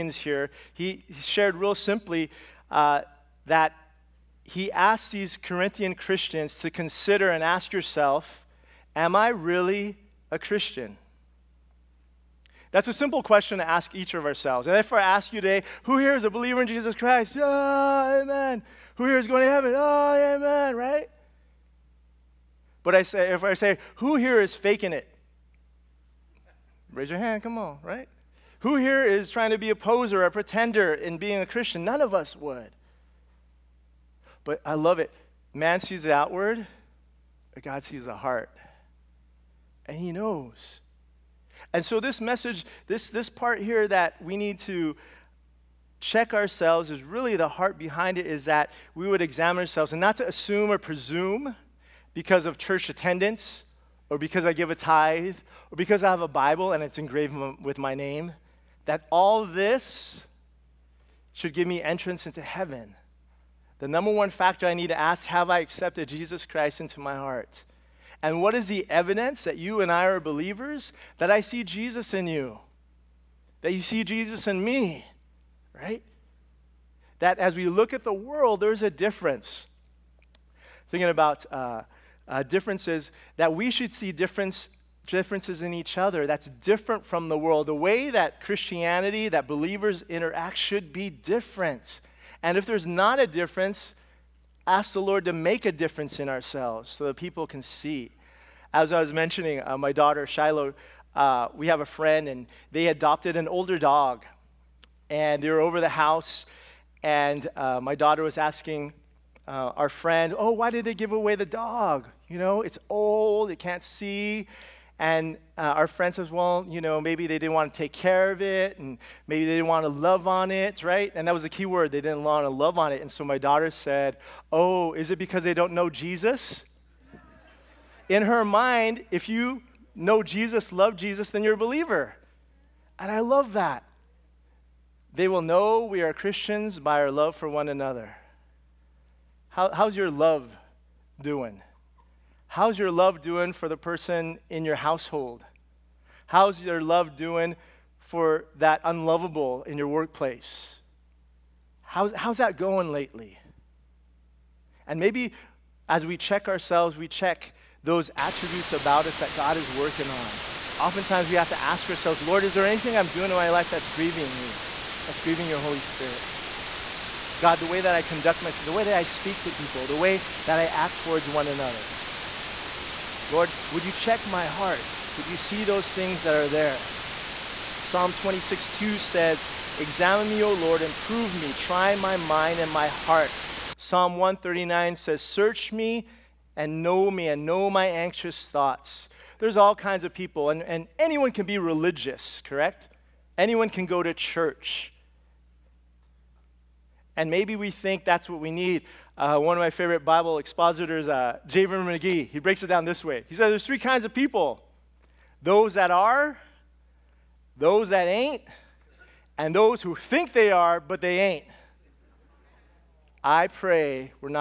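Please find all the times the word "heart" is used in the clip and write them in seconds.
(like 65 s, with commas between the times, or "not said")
38 s, 47 s, 67 s, 174 s, 182 s.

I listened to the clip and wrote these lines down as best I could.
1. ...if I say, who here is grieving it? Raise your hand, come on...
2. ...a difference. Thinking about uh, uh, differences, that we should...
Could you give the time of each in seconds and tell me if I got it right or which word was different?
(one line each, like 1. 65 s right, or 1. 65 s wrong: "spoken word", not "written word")
1. 23 s wrong: "faking", not "grieving"
2. 78 s right.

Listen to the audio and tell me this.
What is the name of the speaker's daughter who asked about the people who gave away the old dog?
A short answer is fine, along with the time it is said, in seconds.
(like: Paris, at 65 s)
Shiloh, at 100 s.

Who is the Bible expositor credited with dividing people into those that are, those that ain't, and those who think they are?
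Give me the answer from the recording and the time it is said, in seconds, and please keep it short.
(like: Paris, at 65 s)
J. Vernon McGee, at 201 s.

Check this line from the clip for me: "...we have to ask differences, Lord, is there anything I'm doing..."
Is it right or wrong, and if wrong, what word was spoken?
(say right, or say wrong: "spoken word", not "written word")
wrong: "ourselves", not "differences".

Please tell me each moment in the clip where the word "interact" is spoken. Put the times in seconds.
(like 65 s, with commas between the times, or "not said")
90 s.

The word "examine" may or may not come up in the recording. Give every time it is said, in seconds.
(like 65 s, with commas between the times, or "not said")
49 s, 179 s.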